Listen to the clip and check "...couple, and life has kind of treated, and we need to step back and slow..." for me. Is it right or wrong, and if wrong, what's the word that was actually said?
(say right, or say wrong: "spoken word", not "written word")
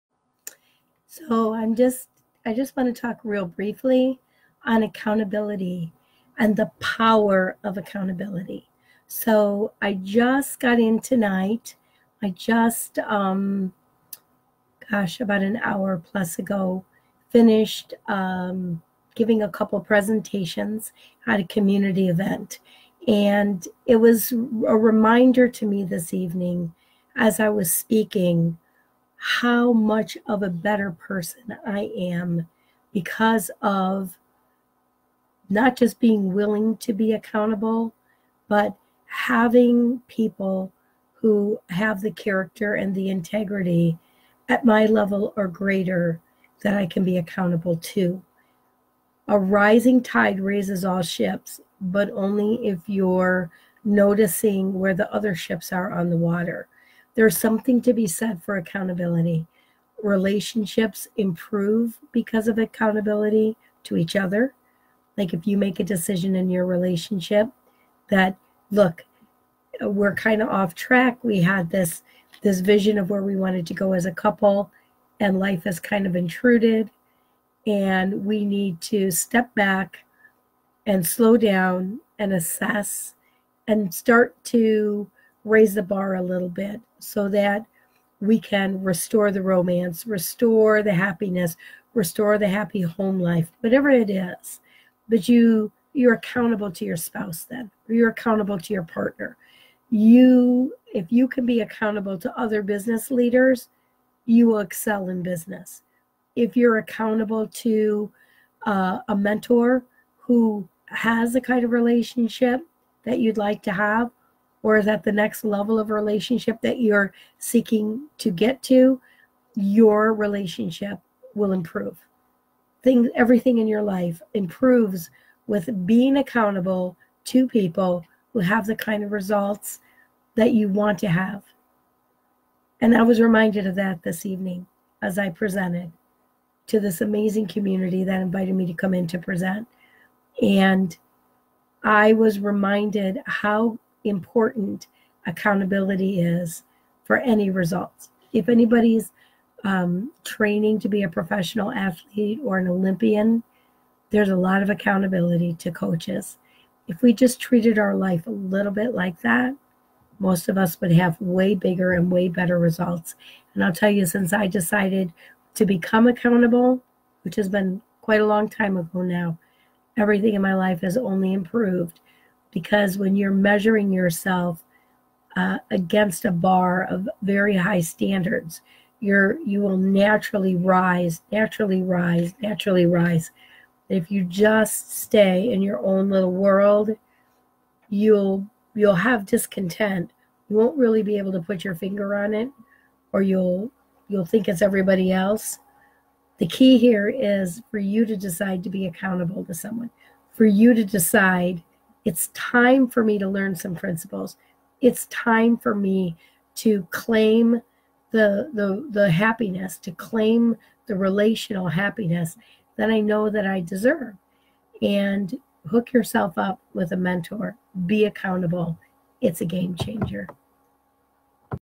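wrong: "intruded", not "treated".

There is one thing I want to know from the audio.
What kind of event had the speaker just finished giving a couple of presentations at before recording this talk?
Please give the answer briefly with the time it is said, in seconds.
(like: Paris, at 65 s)
A community event, at 21 s.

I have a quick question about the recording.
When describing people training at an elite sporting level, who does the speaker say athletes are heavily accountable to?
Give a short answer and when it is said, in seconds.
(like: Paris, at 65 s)
Coaches, at 155 s.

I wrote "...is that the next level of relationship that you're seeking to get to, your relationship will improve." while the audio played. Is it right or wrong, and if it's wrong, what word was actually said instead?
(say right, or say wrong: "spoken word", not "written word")
right.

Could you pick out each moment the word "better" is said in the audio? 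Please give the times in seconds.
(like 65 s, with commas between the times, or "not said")
30 s, 162 s.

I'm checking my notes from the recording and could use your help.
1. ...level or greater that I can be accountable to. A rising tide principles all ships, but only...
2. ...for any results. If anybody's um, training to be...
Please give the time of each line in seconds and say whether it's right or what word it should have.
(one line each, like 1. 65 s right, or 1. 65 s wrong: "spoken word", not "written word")
1. 44 s wrong: "raises", not "principles"
2. 147 s right.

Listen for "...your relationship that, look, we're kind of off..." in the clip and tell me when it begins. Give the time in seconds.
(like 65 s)
66 s.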